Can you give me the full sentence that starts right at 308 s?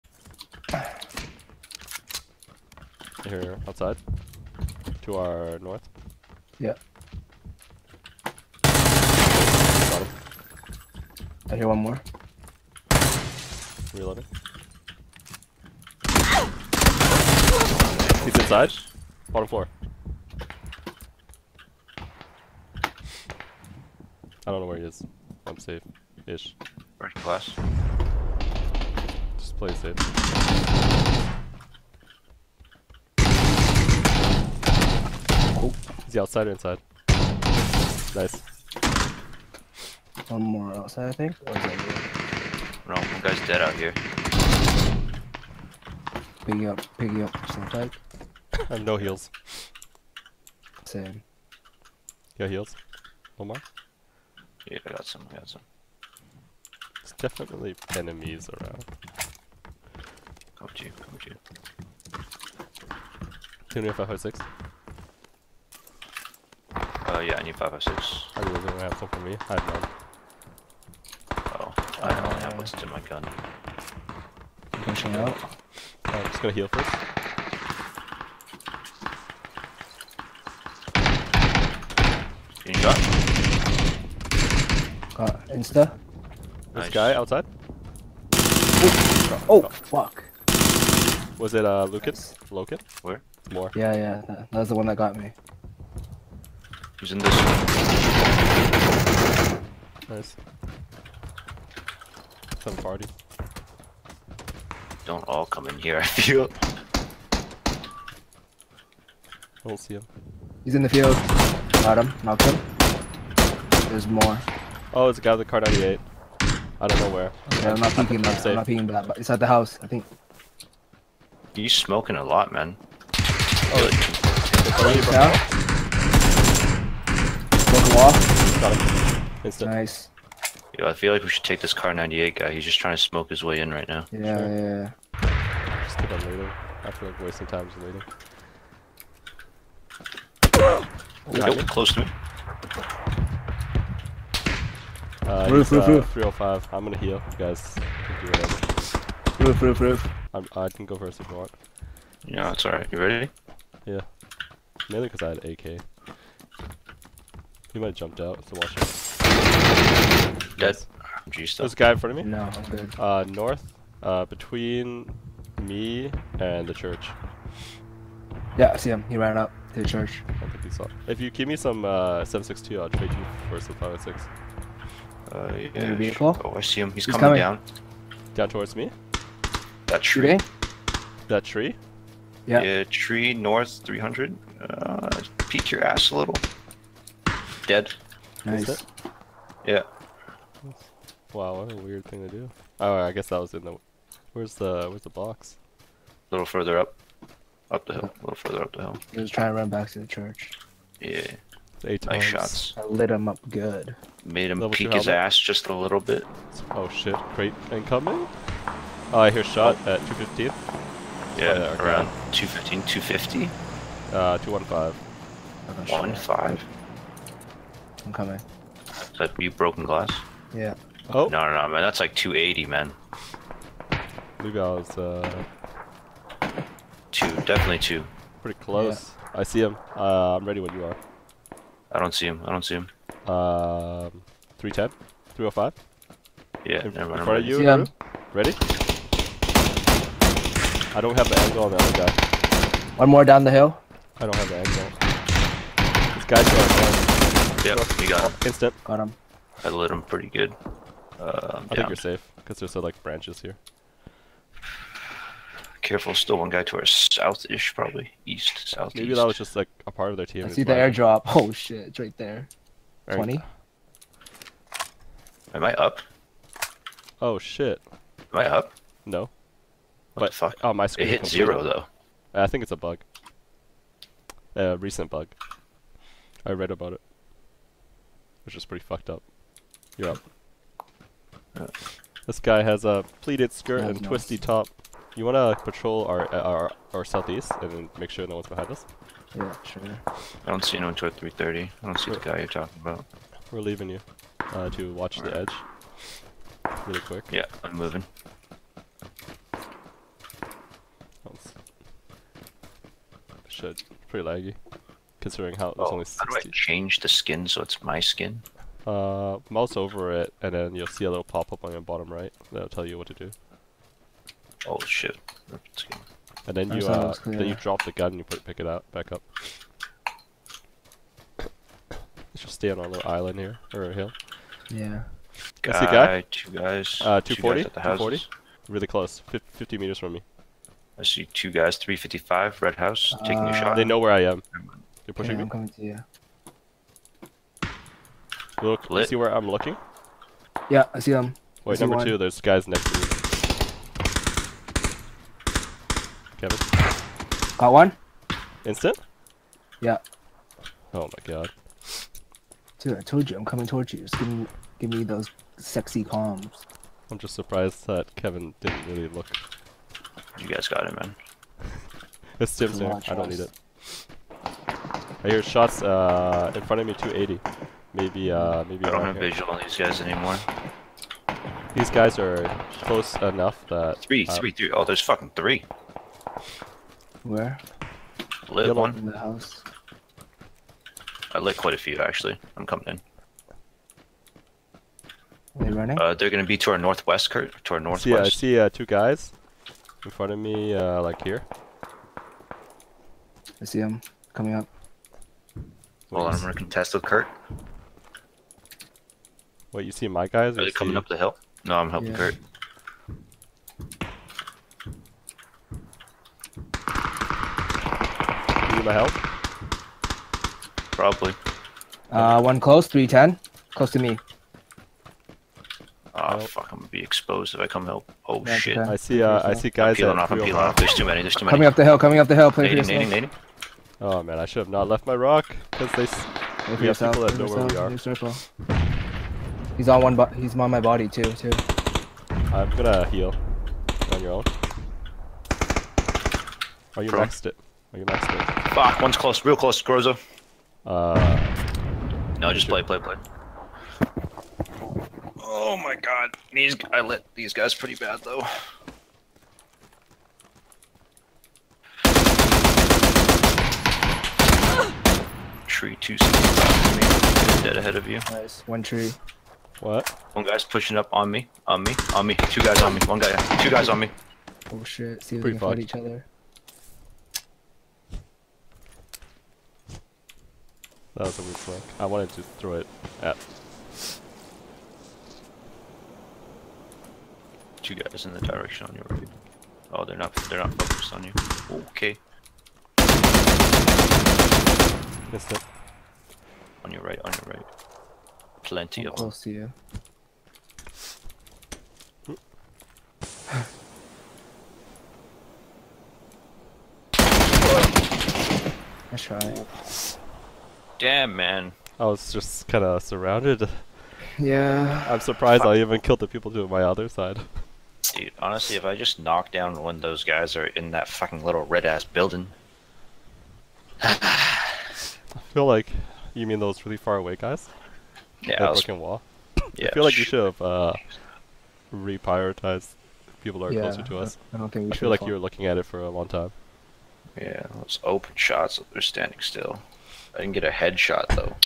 Uh, mouse over it, and then you'll see a little pop-up on your bottom right that'll tell you what to do.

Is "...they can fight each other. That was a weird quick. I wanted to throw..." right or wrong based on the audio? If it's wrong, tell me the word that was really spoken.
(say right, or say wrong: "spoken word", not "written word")
wrong: "flick", not "quick".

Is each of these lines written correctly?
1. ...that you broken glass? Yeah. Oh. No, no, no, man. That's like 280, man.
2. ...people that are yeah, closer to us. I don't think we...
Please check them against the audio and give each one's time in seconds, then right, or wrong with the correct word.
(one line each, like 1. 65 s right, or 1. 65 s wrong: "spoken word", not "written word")
1. 219 s right
2. 523 s right.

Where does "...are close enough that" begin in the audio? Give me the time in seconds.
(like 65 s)
372 s.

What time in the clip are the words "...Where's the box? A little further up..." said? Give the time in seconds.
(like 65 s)
194 s.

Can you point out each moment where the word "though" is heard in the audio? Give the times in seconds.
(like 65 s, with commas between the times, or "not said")
271 s, 448 s, 531 s.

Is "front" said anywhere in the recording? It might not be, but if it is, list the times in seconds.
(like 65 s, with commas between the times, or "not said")
161 s, 237 s, 366 s, 390 s.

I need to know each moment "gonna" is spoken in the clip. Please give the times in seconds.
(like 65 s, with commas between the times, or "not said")
76 s, 146 s, 386 s, 396 s, 416 s, 432 s.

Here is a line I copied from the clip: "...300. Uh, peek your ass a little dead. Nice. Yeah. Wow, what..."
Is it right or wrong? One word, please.
right.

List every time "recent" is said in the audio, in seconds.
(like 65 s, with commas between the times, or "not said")
274 s.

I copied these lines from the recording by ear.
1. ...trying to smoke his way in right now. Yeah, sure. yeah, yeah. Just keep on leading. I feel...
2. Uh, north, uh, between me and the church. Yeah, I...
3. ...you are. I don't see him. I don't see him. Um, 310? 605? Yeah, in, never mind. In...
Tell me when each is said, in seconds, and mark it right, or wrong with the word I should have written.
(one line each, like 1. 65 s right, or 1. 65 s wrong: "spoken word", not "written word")
1. 132 s right
2. 162 s right
3. 230 s wrong: "305", not "605".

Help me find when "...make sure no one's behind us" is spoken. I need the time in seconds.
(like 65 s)
287 s.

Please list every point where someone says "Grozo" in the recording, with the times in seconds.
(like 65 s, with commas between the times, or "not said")
439 s.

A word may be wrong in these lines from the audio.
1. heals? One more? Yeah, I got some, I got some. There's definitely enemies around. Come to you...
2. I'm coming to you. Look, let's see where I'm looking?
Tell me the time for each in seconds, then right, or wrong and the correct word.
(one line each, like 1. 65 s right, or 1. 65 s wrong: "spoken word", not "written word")
1. 52 s right
2. 335 s right.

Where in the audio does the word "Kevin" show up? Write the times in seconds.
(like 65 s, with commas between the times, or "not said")
346 s, 358 s.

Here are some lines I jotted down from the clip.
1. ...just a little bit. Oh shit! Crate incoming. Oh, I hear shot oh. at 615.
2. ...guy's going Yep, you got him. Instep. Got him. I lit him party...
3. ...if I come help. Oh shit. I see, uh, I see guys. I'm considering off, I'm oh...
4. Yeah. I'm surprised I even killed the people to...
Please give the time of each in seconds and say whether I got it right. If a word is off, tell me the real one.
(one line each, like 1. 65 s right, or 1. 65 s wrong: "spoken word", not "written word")
1. 205 s wrong: "215", not "615"
2. 246 s wrong: "pretty", not "party"
3. 417 s wrong: "peeling", not "considering"
4. 504 s right.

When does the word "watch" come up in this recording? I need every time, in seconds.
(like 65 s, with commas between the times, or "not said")
158 s, 294 s.